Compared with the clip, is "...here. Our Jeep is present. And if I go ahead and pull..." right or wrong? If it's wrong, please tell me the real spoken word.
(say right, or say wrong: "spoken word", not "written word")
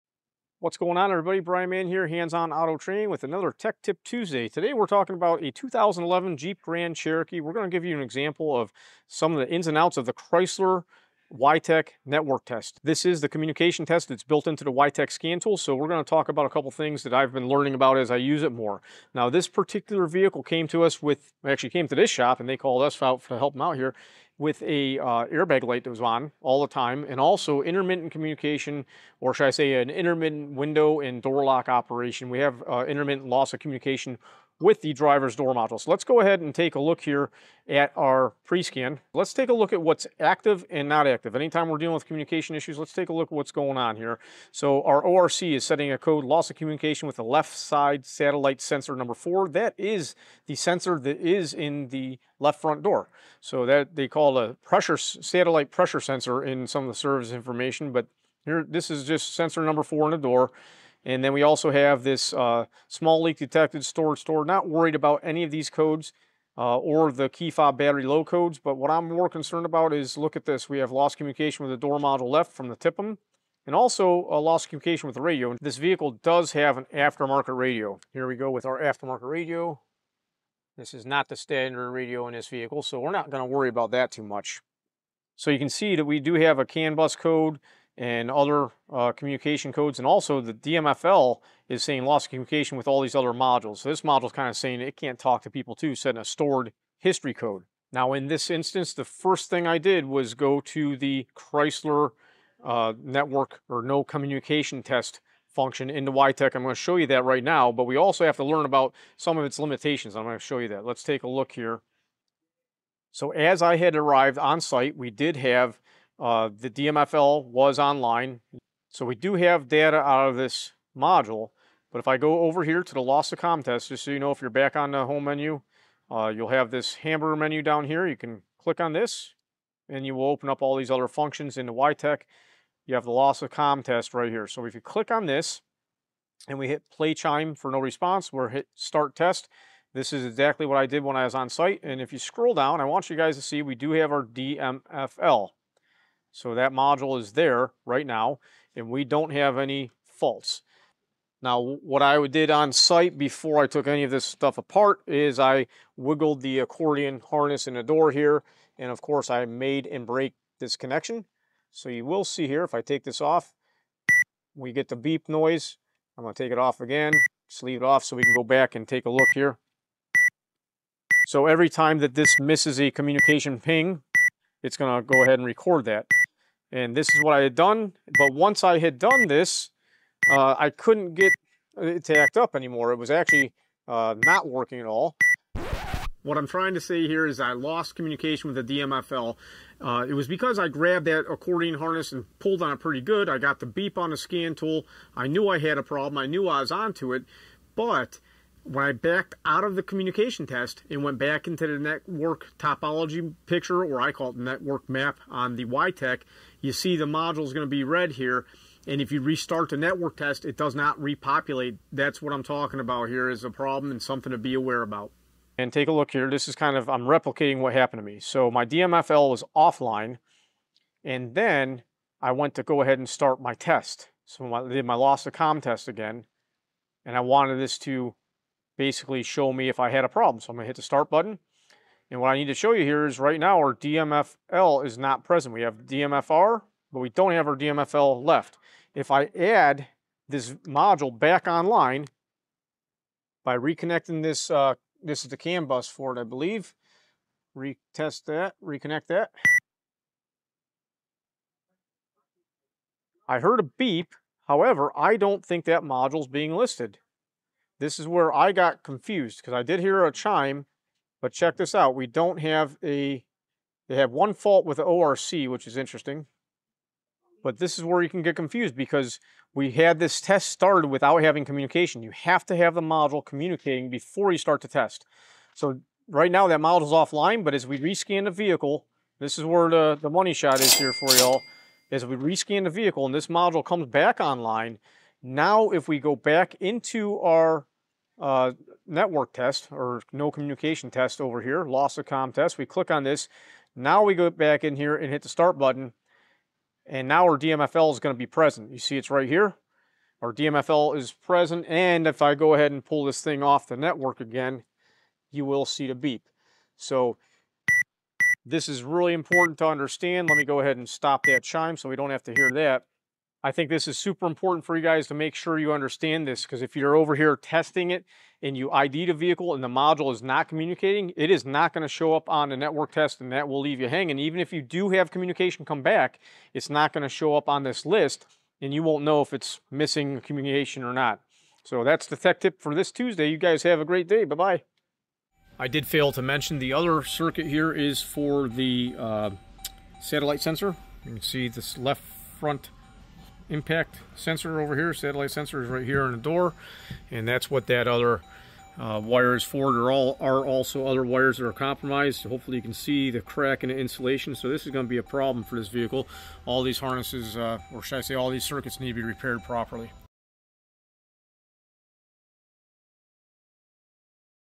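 wrong: "DMFL", not "Jeep".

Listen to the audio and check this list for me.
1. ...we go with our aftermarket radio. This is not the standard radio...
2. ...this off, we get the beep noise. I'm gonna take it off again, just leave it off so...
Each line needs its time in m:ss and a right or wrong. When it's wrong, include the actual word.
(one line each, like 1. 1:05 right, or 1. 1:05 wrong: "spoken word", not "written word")
1. 1:18 right
2. 2:43 right.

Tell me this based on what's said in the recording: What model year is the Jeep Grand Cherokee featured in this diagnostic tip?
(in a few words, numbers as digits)
2011.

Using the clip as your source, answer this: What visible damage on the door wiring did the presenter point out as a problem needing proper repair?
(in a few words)
crack in the insulation.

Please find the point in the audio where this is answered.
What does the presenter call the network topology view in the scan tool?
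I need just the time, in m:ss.
3:24.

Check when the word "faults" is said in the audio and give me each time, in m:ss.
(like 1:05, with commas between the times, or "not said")
2:30, 4:24.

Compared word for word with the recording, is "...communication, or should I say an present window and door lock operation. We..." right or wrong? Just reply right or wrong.
wrong.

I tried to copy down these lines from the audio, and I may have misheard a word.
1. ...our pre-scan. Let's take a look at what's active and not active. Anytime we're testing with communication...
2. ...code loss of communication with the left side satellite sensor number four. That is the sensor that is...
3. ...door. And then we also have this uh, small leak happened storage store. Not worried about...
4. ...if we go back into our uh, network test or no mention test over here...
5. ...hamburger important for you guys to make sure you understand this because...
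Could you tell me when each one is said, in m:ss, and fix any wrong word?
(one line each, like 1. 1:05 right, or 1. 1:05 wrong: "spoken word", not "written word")
1. 0:37 wrong: "dealing", not "testing"
2. 0:45 right
3. 1:00 wrong: "detected", not "happened"
4. 4:45 wrong: "communication", not "mention"
5. 5:13 wrong: "super", not "hamburger".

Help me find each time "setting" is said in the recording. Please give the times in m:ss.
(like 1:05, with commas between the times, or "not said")
0:45, 1:35.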